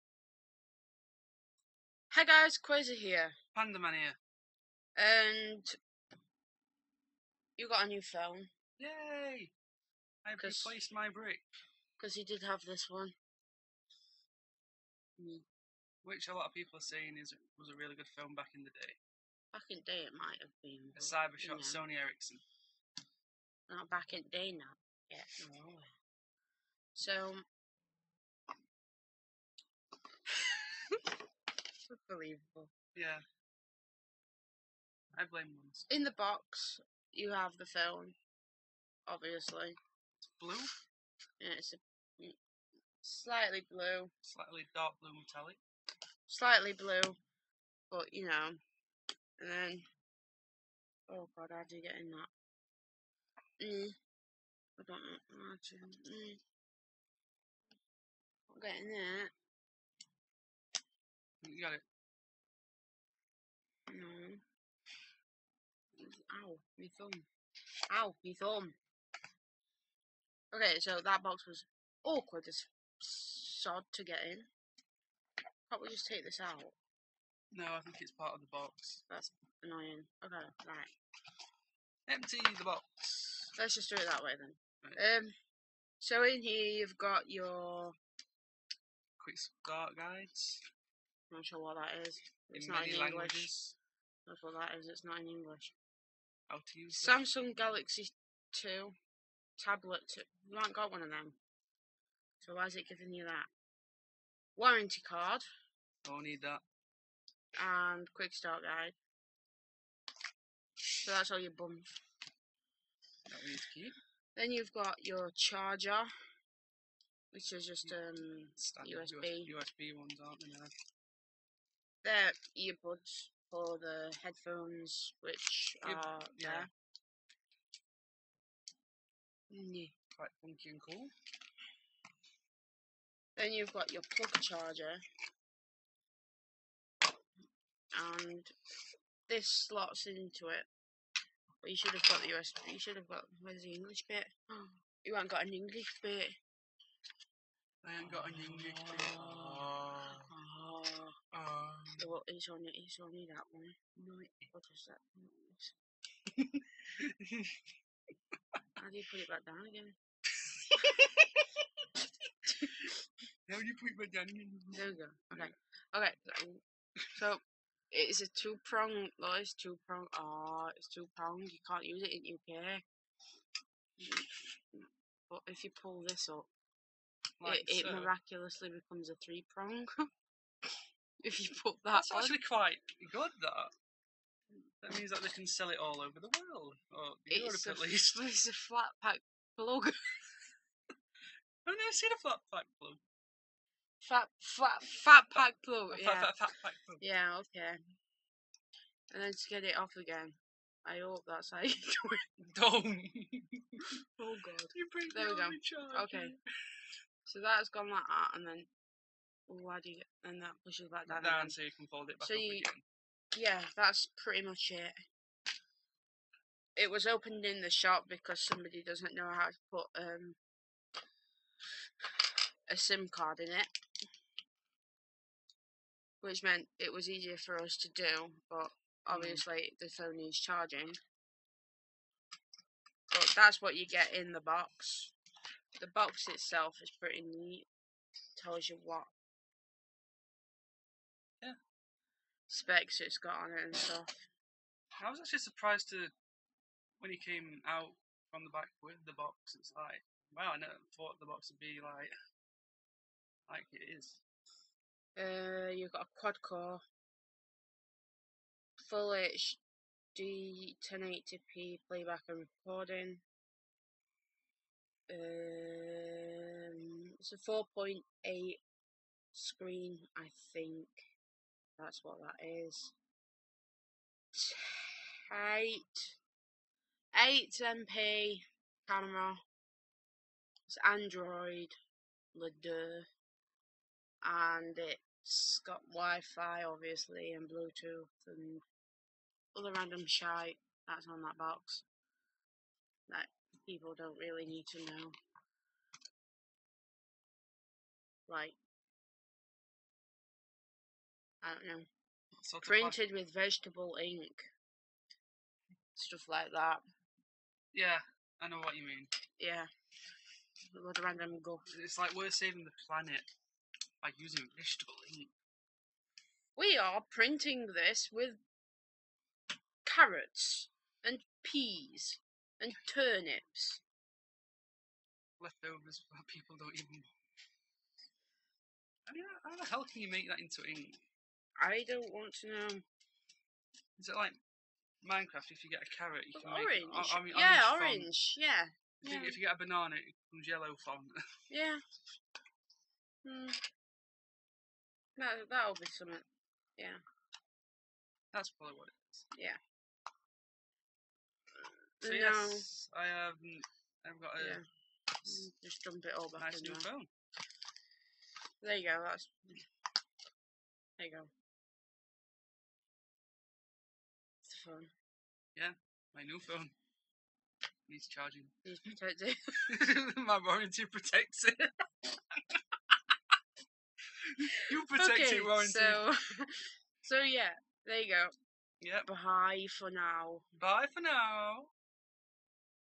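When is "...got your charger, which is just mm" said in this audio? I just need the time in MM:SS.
01:54.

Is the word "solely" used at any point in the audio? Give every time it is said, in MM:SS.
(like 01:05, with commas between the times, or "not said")
not said.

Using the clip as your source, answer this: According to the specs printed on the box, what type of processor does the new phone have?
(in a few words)
quad core.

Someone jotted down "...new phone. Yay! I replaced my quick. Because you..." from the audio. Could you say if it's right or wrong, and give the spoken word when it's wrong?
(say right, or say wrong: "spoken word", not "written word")
wrong: "brick", not "quick".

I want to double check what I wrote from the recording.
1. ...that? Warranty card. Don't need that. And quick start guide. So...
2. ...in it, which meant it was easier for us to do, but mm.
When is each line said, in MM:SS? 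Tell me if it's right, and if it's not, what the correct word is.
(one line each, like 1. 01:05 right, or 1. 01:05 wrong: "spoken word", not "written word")
1. 01:43 right
2. 03:43 right.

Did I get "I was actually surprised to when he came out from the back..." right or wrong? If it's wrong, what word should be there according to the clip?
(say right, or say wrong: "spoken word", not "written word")
right.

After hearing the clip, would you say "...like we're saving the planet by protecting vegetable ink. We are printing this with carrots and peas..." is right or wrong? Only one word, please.
wrong.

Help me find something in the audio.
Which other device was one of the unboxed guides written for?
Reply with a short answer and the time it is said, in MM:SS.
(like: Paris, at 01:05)
Galaxy 2 tablet, at 01:37.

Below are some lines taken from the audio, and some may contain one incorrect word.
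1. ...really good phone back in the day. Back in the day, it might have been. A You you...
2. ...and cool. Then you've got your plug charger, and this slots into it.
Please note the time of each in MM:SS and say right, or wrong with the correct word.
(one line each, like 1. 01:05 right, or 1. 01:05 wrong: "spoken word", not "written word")
1. 00:17 wrong: "Cybershot", not "You"
2. 02:10 right.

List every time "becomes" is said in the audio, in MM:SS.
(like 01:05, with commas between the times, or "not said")
02:58, 05:40.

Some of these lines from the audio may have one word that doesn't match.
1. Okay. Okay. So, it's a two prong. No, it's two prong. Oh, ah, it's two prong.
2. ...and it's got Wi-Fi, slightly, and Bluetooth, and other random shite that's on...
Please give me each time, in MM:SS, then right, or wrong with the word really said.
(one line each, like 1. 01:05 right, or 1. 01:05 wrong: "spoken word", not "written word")
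1. 02:45 right
2. 04:44 wrong: "obviously", not "slightly".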